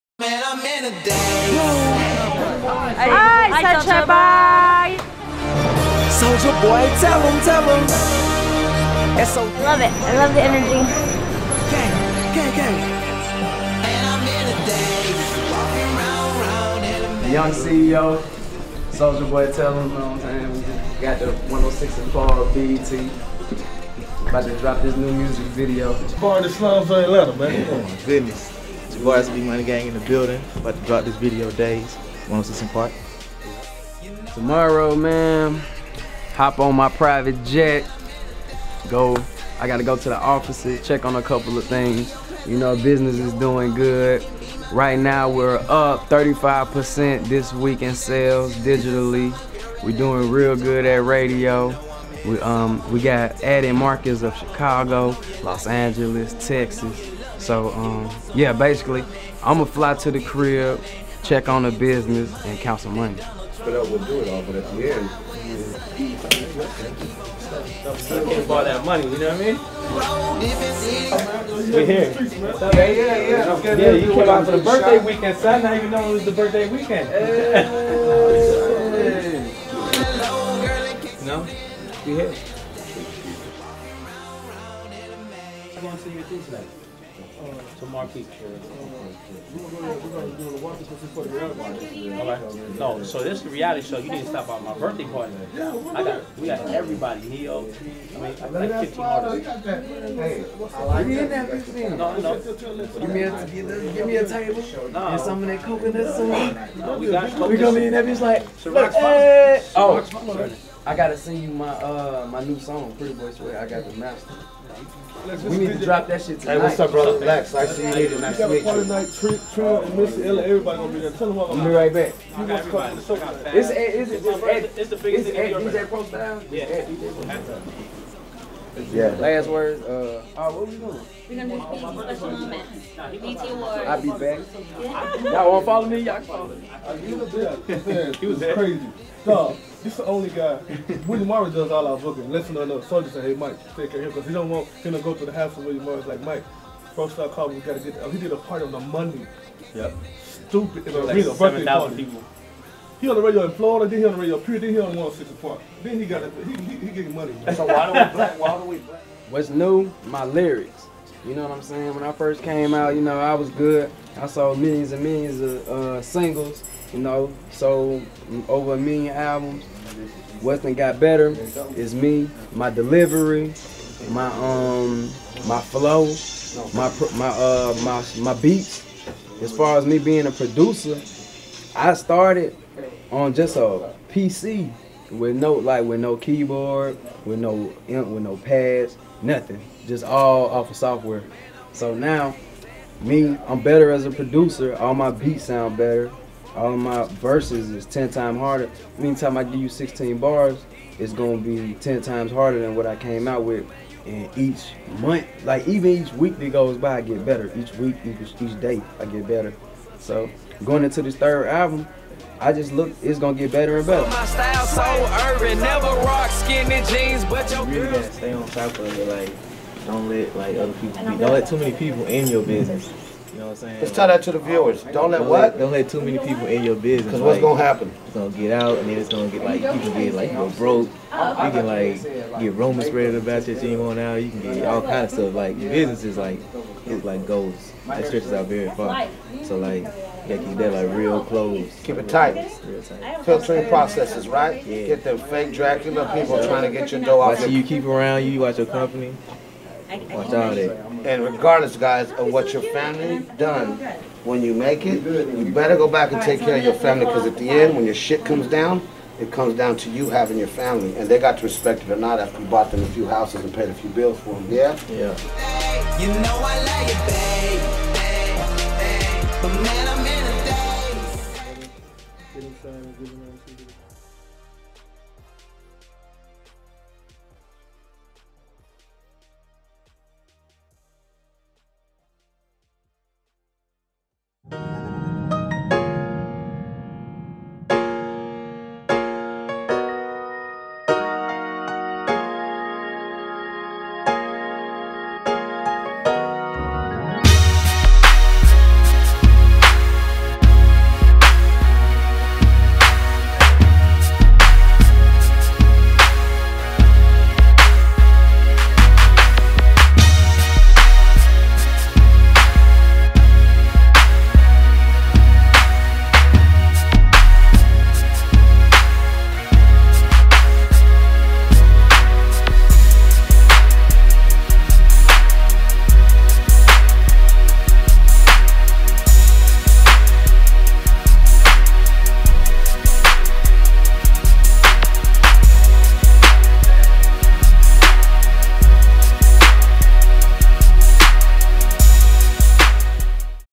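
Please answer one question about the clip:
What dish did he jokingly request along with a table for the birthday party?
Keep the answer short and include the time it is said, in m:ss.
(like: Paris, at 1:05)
Coconut soup, at 1:45.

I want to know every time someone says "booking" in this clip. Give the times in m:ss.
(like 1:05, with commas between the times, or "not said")
2:21.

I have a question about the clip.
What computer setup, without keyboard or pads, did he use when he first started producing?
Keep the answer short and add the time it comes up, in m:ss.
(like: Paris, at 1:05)
A PC, at 3:03.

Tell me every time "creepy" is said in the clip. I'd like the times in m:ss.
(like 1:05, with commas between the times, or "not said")
not said.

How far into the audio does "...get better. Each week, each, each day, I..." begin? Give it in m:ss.
3:27.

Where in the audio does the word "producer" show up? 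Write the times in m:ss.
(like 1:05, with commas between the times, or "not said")
3:00, 3:14.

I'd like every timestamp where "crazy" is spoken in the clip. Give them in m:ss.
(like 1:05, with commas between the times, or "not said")
2:18.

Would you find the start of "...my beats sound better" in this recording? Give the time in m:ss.
3:14.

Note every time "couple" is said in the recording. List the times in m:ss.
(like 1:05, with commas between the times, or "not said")
0:41.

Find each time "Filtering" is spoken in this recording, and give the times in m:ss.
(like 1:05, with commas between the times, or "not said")
4:03.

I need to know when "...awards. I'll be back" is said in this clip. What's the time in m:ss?
2:13.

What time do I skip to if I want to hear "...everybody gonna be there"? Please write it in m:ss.
2:00.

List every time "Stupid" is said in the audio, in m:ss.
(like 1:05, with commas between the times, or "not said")
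2:30.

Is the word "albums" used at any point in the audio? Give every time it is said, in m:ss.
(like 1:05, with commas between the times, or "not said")
2:49, 3:31.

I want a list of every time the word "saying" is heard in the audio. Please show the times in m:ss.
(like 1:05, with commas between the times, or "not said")
0:20, 2:41, 3:43.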